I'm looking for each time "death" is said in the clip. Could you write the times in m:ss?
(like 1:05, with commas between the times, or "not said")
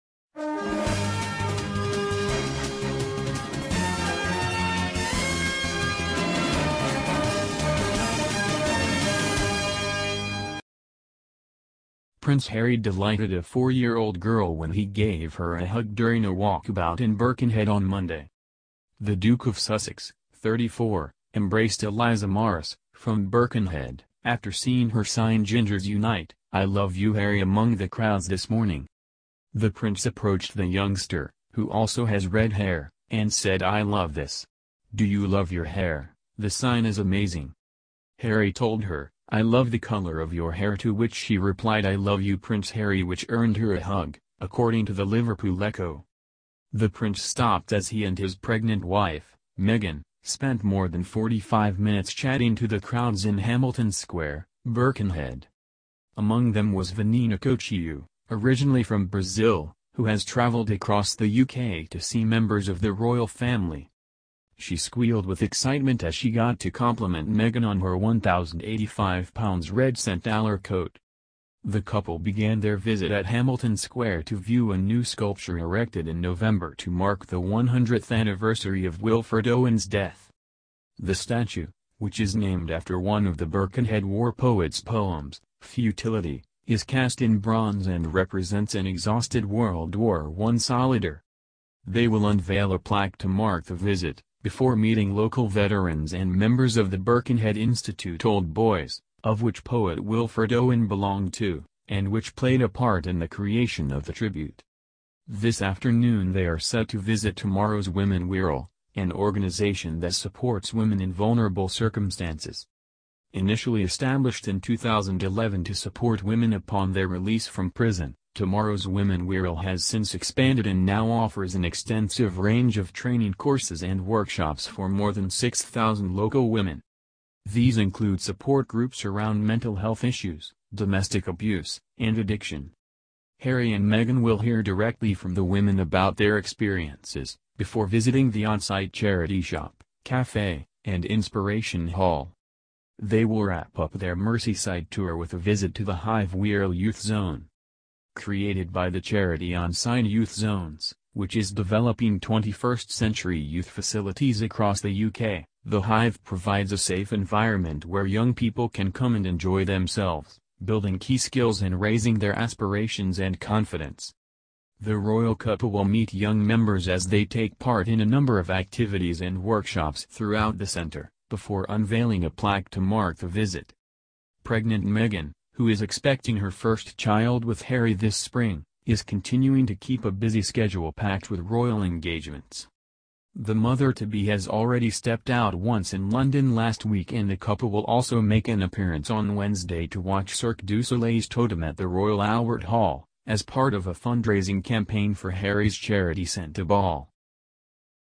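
1:19.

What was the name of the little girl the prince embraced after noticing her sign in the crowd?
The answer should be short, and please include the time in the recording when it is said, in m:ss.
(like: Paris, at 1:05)
Eliza Morris, at 0:21.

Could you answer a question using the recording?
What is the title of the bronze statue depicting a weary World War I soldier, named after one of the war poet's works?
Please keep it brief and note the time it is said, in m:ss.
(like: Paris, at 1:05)
Futility, at 1:25.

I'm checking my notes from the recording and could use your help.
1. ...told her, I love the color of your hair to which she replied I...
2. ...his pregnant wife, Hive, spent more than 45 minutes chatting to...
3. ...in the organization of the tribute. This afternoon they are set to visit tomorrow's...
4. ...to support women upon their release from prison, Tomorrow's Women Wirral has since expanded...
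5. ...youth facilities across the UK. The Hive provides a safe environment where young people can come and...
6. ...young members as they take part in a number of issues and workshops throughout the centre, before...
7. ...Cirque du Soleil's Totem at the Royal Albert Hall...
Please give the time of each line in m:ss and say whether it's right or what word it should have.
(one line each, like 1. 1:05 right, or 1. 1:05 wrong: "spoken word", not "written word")
1. 0:38 right
2. 0:48 wrong: "Meghan", not "Hive"
3. 1:43 wrong: "creation", not "organization"
4. 1:55 right
5. 2:33 right
6. 2:46 wrong: "activities", not "issues"
7. 3:10 right.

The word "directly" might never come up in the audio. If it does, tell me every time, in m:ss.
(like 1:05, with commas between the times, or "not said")
2:14.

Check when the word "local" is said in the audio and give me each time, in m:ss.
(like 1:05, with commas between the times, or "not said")
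1:35, 2:06.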